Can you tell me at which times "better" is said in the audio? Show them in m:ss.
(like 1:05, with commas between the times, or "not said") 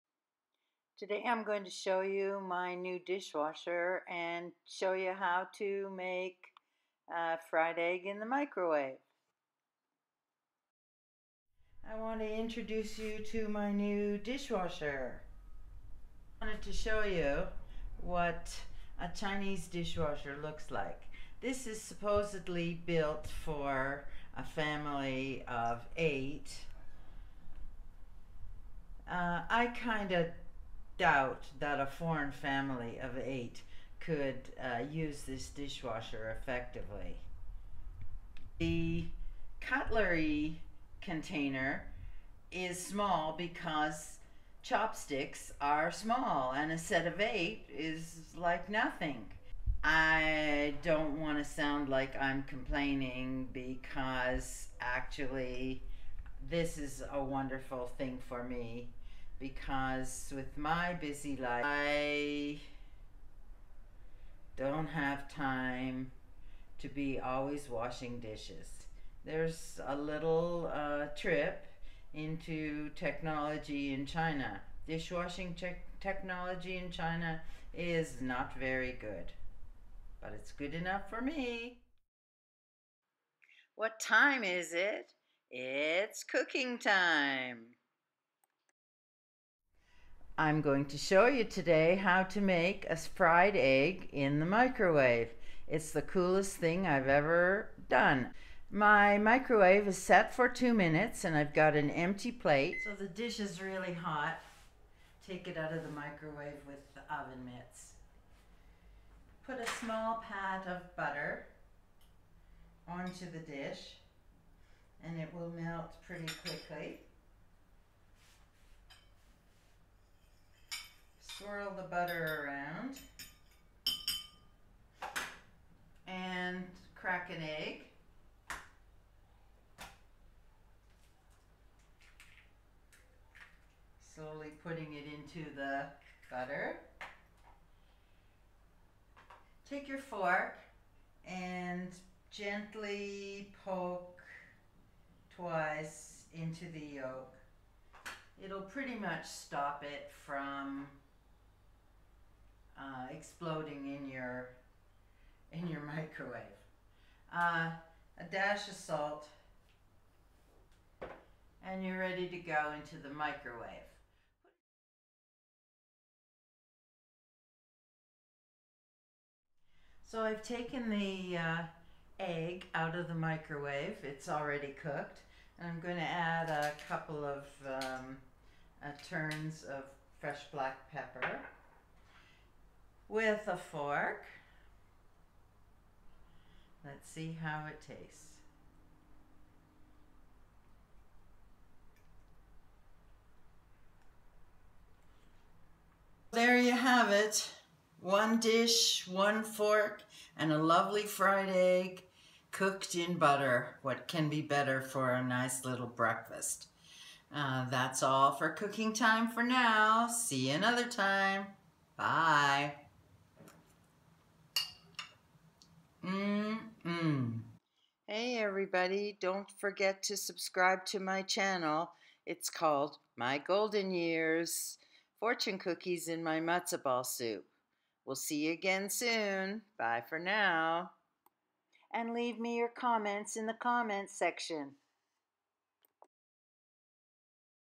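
3:24.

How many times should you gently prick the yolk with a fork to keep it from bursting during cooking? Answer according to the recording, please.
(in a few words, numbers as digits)
twice.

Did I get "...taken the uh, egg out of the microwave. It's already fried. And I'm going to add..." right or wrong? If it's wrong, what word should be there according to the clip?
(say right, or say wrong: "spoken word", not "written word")
wrong: "cooked", not "fried".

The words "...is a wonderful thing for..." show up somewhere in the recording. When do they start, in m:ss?
0:56.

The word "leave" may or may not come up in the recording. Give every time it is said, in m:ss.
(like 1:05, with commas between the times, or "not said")
3:52.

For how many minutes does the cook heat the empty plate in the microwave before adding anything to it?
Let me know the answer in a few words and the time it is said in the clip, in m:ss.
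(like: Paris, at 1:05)
2, at 1:40.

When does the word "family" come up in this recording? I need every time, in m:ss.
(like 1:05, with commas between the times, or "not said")
0:24, 0:32.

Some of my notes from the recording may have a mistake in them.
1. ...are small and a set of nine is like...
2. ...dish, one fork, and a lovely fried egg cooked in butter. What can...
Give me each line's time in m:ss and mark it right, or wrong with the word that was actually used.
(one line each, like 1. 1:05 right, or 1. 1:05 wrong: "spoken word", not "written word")
1. 0:45 wrong: "eight", not "nine"
2. 3:18 right.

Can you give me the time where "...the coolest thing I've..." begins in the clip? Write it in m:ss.
1:35.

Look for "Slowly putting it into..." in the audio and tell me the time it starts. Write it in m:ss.
2:14.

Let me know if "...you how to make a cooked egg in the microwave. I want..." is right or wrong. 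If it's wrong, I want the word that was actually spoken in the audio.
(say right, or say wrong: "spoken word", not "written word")
wrong: "fried", not "cooked".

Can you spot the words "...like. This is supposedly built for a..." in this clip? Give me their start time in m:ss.
0:20.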